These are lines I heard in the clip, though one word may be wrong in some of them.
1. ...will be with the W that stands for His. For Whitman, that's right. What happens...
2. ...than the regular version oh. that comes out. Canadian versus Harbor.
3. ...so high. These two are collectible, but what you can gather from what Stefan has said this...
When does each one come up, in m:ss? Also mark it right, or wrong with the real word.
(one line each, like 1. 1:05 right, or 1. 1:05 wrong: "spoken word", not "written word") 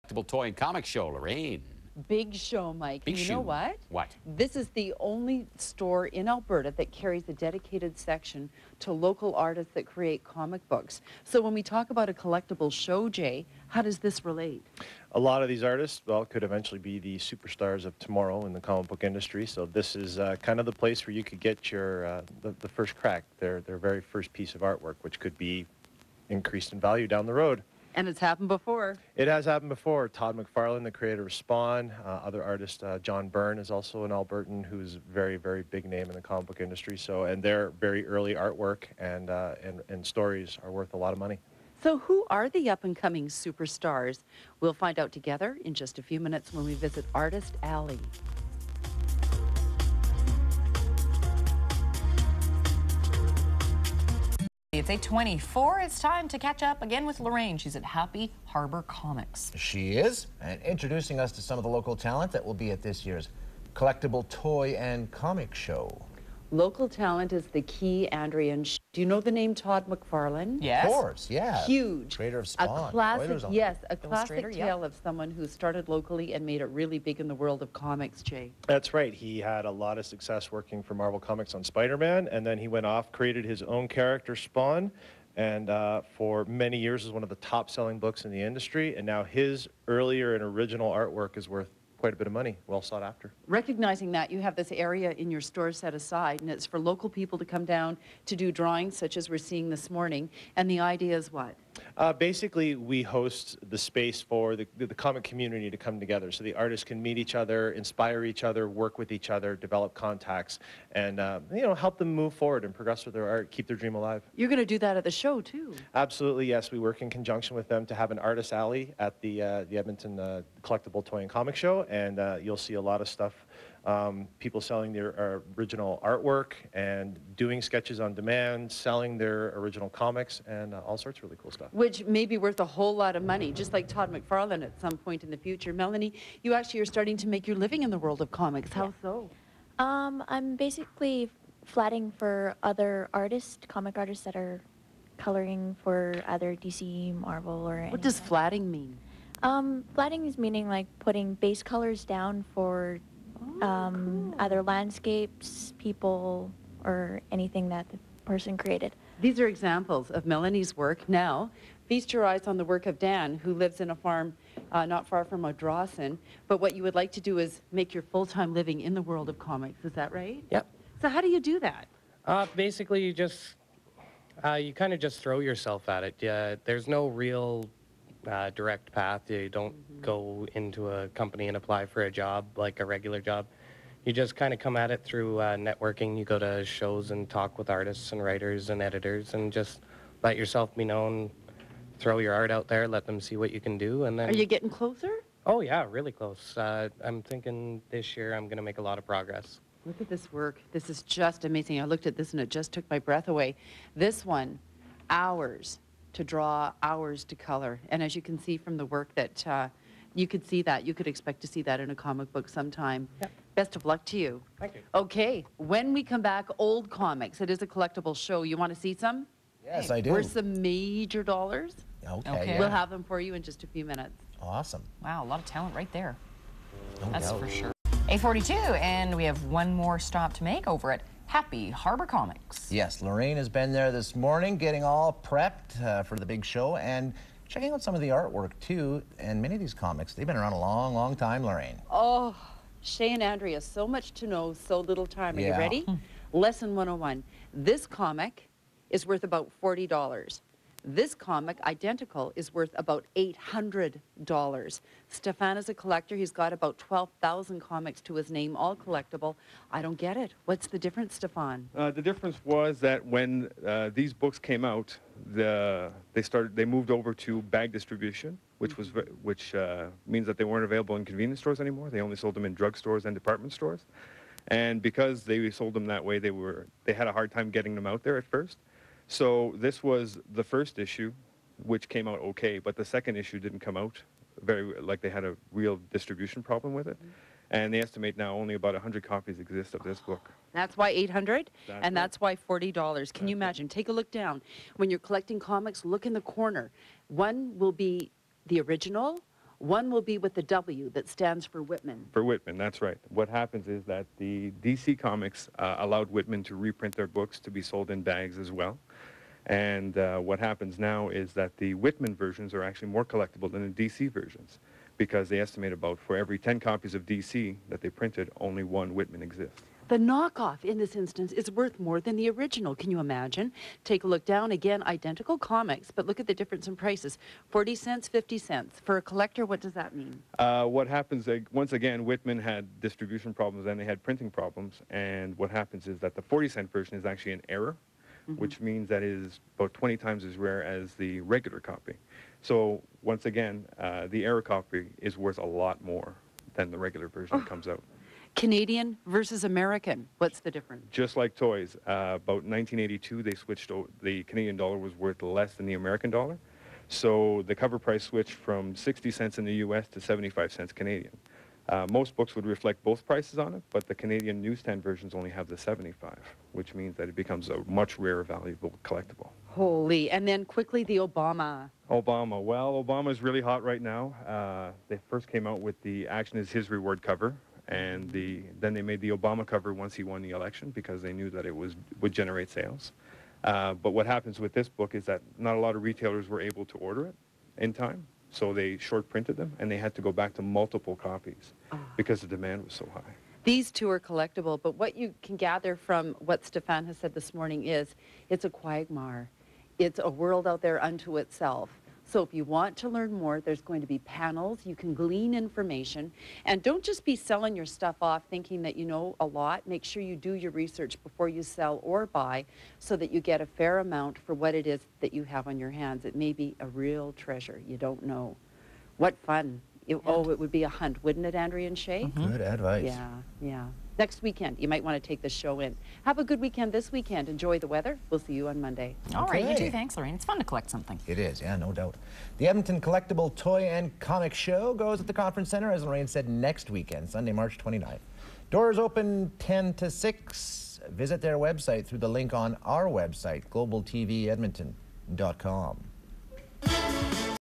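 1. 4:59 wrong: "Whitman", not "His"
2. 5:46 wrong: "American", not "Harbor"
3. 6:32 right.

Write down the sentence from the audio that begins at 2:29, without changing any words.
Um, flatting is meaning like putting base colors down for um, either landscapes, people, or anything that the person created.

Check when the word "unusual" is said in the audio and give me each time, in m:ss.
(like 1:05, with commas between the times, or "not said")
not said.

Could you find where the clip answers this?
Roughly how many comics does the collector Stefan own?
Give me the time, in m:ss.
4:16.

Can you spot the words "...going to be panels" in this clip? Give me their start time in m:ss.
6:43.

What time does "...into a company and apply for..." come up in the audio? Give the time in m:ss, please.
3:00.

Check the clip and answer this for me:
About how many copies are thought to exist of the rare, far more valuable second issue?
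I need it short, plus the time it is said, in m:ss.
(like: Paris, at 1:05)
100, at 4:48.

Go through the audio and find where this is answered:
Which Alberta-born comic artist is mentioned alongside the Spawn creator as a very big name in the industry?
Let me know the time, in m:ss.
0:32.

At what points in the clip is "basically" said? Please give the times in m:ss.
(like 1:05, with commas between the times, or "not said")
1:42, 2:20, 2:52.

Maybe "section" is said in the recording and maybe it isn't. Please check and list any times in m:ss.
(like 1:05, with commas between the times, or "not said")
0:07.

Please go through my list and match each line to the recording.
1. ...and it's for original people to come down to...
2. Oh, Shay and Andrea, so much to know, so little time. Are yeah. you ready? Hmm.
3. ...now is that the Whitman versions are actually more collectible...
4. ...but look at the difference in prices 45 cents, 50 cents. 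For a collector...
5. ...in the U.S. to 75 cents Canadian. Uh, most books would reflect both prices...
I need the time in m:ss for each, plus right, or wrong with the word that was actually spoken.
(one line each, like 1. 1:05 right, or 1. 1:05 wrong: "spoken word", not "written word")
1. 1:36 wrong: "local", not "original"
2. 4:01 right
3. 5:10 right
4. 5:25 wrong: "40", not "45"
5. 5:59 right.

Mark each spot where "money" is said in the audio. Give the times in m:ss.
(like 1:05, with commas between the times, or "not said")
0:41, 1:32, 2:13.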